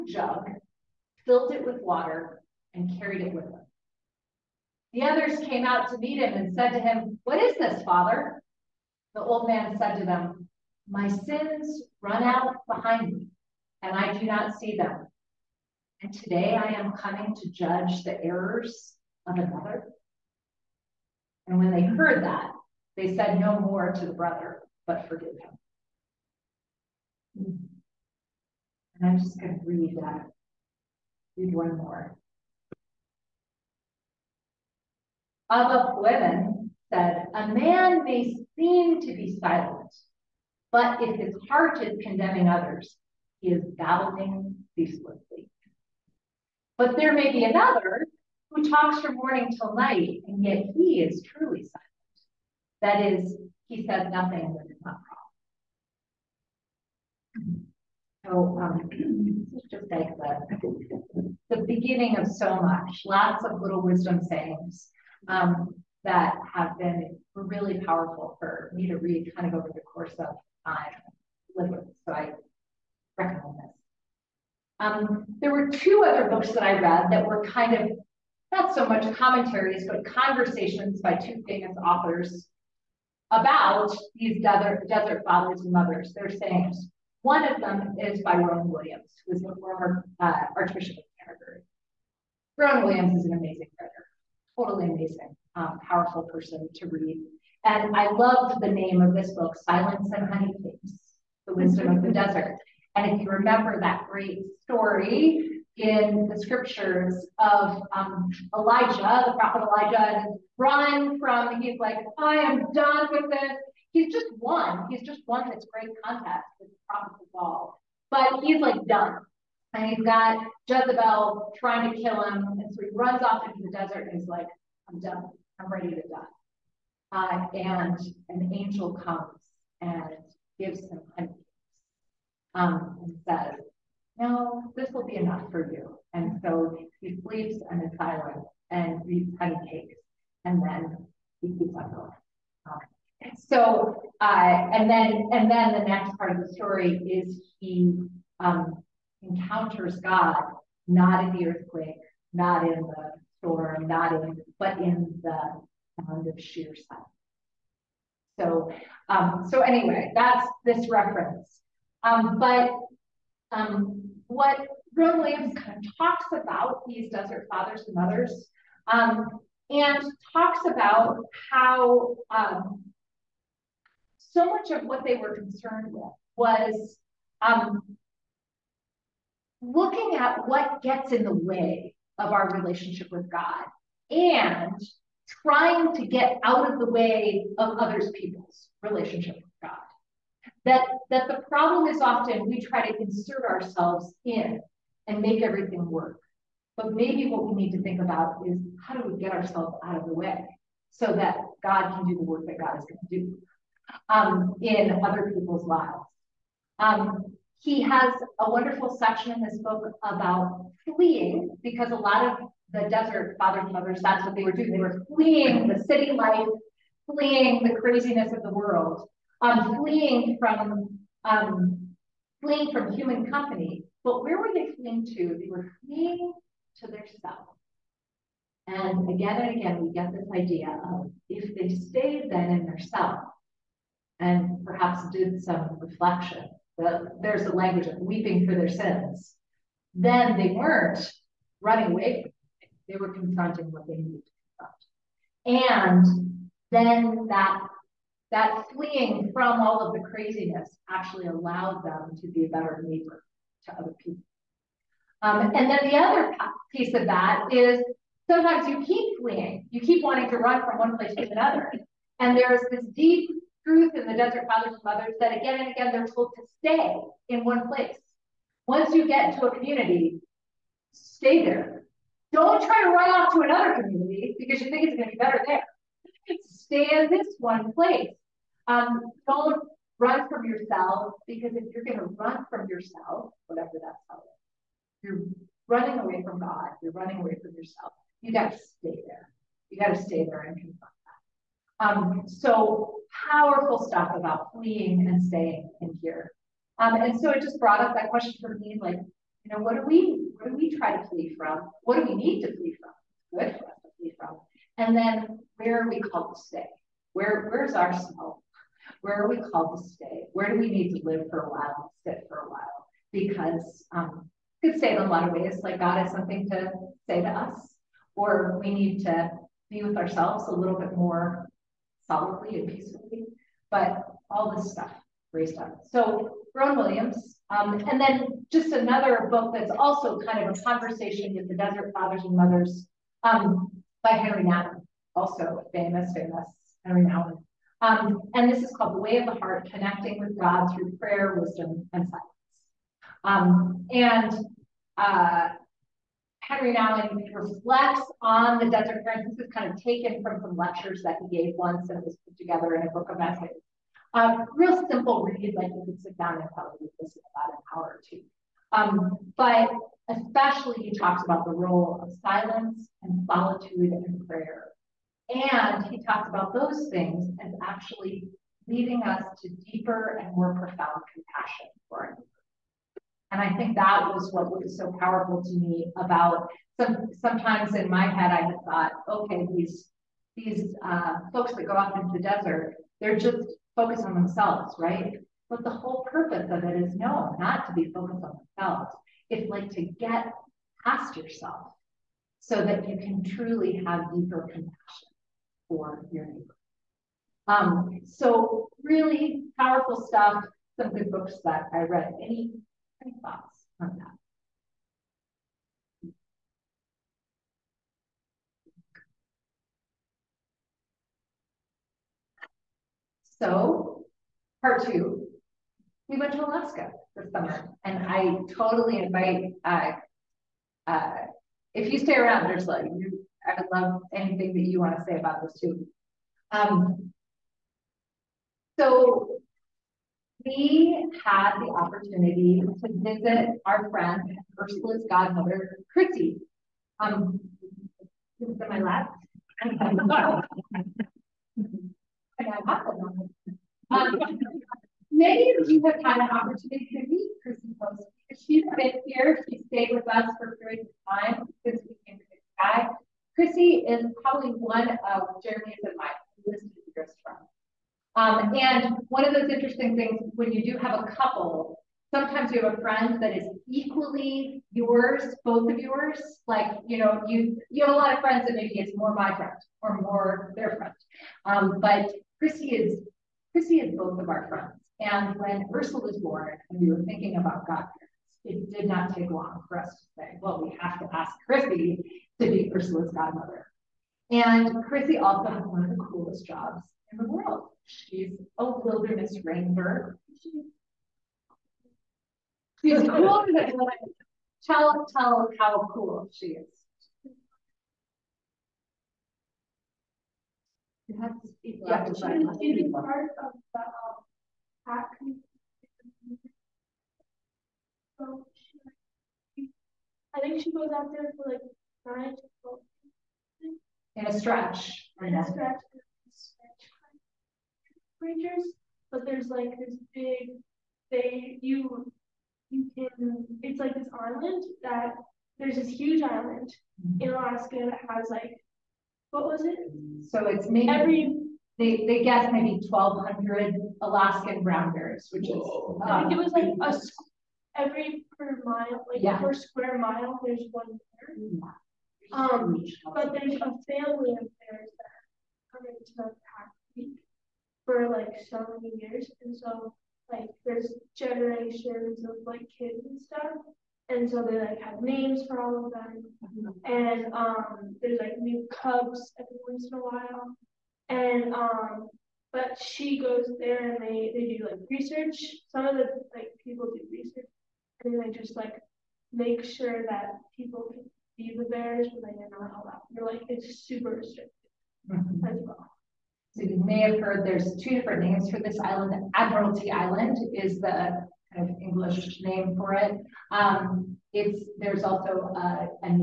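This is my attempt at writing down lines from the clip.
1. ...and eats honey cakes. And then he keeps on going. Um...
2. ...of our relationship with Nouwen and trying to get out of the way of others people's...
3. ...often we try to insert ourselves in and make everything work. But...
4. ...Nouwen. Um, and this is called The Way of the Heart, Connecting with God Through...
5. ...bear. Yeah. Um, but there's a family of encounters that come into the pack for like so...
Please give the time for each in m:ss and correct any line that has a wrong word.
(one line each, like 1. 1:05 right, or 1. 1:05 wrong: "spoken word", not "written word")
1. 2:18 right
2. 3:02 wrong: "God", not "Nouwen"
3. 3:12 right
4. 5:37 right
5. 9:00 wrong: "bears", not "encounters".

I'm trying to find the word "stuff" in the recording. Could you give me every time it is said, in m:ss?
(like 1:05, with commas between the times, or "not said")
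4:53, 5:24, 6:40, 9:13.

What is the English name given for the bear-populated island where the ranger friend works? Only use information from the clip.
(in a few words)
Admiralty Island.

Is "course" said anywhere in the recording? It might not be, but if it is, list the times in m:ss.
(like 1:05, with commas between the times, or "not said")
1:09.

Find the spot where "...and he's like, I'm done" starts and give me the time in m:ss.
2:04.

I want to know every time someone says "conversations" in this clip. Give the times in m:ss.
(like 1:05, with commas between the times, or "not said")
1:20, 5:30.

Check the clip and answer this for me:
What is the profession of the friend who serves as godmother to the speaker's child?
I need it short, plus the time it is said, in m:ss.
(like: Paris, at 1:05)
Wilderness ranger, at 8:08.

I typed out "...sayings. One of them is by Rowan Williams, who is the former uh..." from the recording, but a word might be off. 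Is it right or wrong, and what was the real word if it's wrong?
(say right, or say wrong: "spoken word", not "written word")
right.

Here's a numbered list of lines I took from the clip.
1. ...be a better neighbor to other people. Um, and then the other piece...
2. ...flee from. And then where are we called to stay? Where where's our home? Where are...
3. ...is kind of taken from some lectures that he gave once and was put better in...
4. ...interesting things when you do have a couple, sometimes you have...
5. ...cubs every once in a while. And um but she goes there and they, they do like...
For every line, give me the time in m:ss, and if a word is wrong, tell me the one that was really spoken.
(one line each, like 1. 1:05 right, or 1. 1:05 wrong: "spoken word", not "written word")
1. 4:12 right
2. 5:03 right
3. 5:49 wrong: "together", not "better"
4. 7:39 right
5. 9:18 right.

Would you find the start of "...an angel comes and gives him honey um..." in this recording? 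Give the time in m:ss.
2:08.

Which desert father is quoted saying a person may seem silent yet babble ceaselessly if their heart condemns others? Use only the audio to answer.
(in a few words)
Abba Fueven.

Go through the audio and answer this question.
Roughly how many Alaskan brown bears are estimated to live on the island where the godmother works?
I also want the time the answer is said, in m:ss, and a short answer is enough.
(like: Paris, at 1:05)
1200, at 8:52.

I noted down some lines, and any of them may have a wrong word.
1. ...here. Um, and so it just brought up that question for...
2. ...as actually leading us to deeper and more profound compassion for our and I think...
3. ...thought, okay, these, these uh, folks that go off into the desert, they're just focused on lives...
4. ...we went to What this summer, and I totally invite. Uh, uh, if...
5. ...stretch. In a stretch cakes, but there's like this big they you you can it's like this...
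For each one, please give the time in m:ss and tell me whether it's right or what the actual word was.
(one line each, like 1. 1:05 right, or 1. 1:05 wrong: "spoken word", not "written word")
1. 4:56 right
2. 6:07 right
3. 6:18 wrong: "themselves", not "lives"
4. 6:56 wrong: "Alaska", not "What"
5. 8:34 wrong: "creatures", not "cakes".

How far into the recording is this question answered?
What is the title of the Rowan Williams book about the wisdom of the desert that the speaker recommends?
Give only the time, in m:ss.
1:39.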